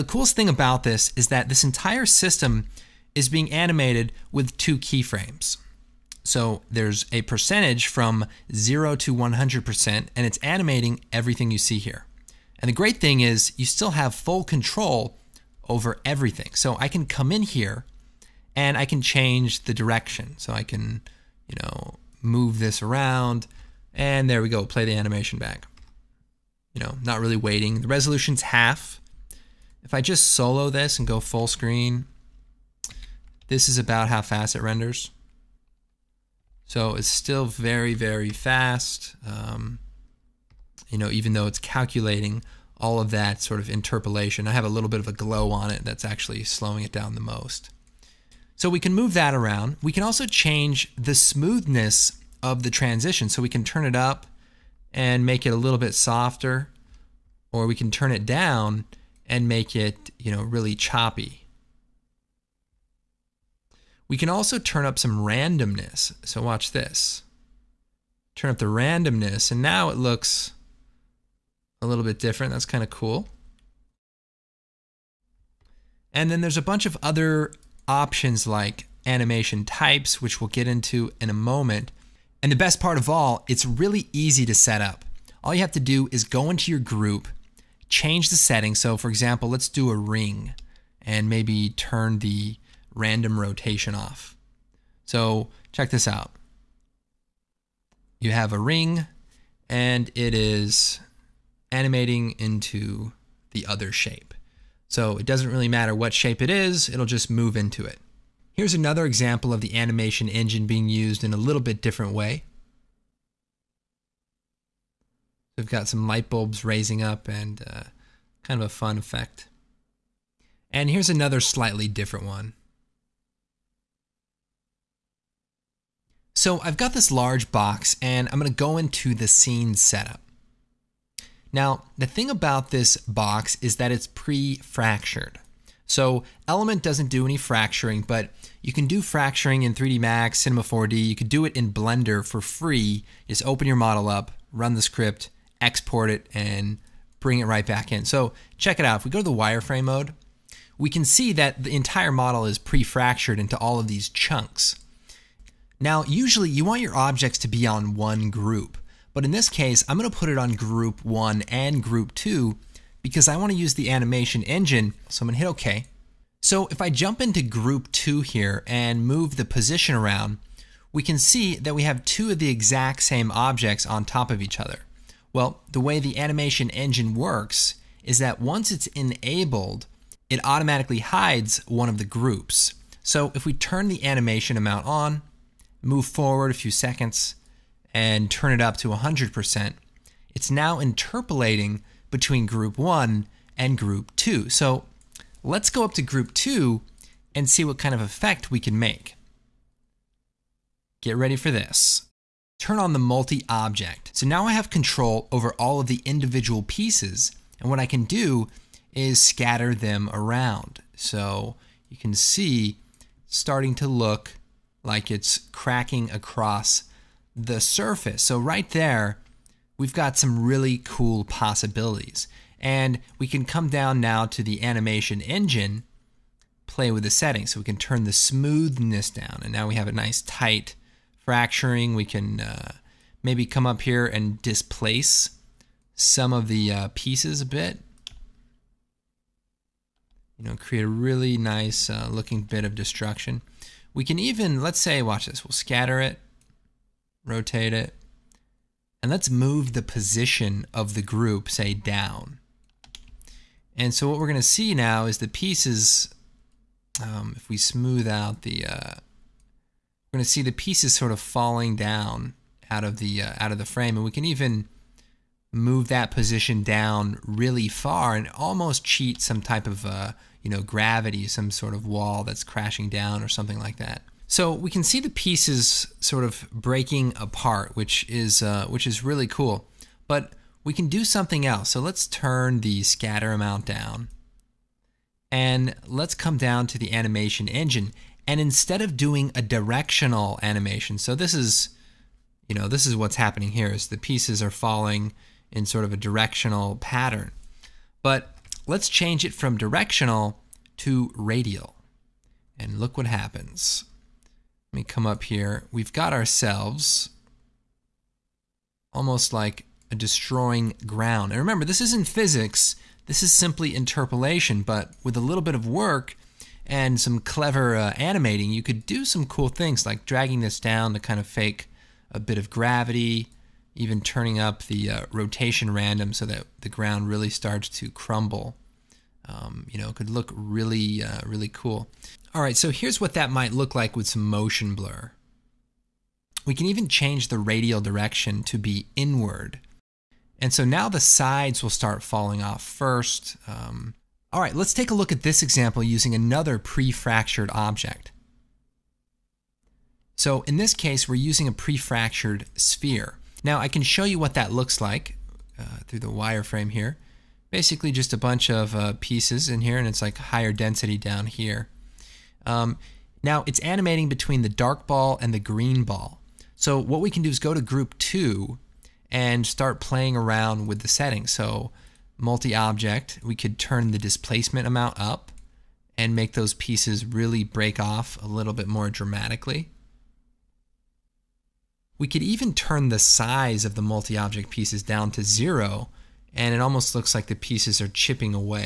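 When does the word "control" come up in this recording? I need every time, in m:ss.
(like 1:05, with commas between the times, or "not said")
0:14, 3:24.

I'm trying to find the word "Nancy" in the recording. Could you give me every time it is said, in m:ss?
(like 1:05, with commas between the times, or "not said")
not said.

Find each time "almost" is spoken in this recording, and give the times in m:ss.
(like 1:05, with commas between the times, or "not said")
4:28, 5:08, 6:26.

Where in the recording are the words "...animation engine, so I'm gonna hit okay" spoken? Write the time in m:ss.
2:43.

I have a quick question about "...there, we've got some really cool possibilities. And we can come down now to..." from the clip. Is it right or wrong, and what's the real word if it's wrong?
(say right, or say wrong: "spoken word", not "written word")
right.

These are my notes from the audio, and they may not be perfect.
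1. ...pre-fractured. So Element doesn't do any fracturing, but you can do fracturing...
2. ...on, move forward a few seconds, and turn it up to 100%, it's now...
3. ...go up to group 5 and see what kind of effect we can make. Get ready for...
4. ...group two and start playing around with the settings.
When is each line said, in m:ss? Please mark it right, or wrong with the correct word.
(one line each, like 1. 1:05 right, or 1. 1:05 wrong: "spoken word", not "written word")
1. 2:14 right
2. 3:04 right
3. 3:15 wrong: "2", not "5"
4. 6:07 right.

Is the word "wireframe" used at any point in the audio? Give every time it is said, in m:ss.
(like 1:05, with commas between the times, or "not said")
2:29, 5:56.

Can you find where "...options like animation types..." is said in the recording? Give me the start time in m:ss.
1:17.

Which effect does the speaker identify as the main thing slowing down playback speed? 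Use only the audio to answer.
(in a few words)
glow.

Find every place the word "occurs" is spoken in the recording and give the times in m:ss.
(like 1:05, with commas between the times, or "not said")
not said.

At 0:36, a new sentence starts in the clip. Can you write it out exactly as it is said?
So it's still very, very fast.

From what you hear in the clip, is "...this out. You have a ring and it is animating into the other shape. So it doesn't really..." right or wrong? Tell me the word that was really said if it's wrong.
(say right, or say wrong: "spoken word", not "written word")
right.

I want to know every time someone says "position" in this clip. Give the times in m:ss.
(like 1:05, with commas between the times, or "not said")
2:49, 4:09, 4:26.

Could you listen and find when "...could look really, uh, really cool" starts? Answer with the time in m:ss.
5:29.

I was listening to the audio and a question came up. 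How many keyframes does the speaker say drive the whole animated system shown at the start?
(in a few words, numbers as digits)
2.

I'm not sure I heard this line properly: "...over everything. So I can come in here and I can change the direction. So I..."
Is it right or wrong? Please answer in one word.
right.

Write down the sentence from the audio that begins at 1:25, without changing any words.
All you have to do is go into your group change the setting.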